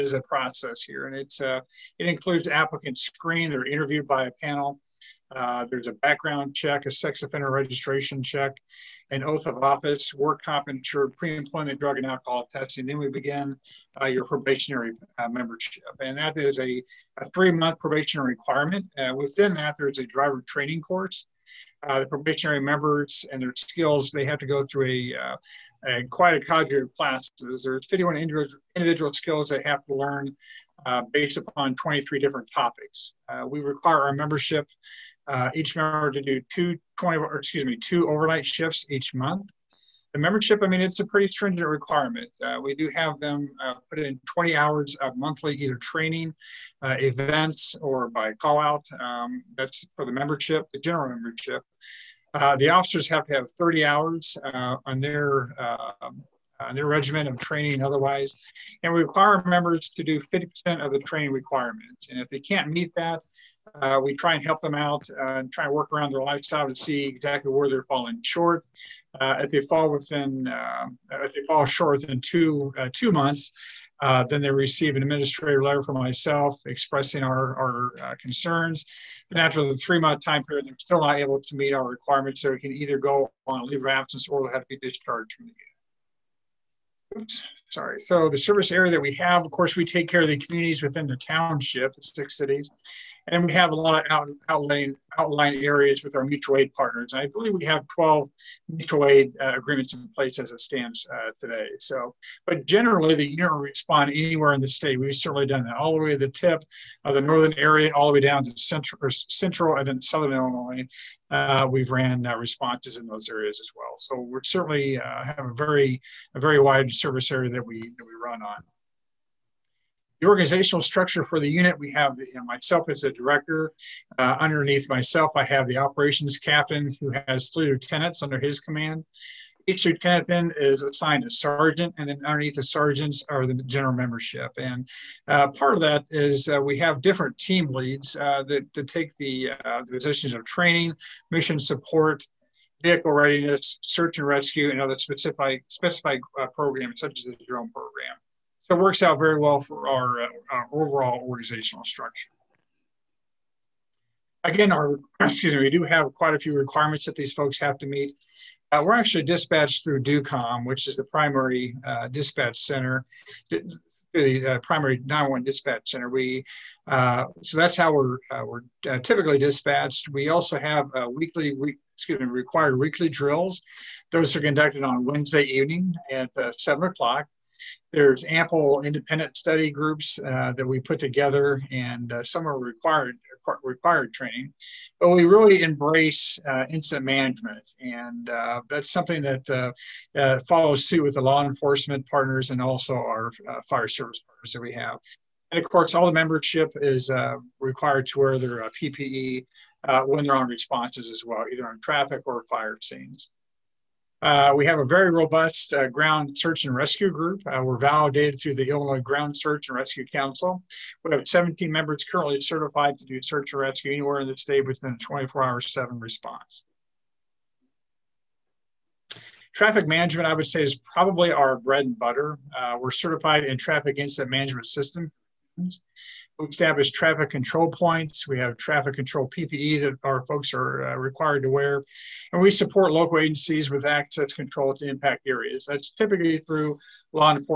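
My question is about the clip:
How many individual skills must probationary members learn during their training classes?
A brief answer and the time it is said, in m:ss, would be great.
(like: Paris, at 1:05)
51, at 0:27.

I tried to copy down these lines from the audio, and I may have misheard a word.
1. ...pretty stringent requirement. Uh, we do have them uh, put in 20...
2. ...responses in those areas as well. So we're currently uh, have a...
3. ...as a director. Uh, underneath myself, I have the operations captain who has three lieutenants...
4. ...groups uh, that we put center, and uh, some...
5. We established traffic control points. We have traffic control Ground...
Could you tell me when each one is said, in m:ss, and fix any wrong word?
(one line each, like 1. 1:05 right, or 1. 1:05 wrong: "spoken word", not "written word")
1. 0:41 right
2. 1:52 wrong: "certainly", not "currently"
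3. 2:02 right
4. 2:59 wrong: "together", not "center"
5. 3:46 wrong: "PPE", not "Ground".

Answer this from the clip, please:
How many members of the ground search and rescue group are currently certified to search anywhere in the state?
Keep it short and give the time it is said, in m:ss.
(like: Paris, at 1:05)
17, at 3:31.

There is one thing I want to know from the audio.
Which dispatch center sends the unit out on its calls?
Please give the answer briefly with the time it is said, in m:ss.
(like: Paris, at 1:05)
DUCOM, at 2:40.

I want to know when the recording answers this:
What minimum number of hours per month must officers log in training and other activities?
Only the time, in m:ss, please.
0:53.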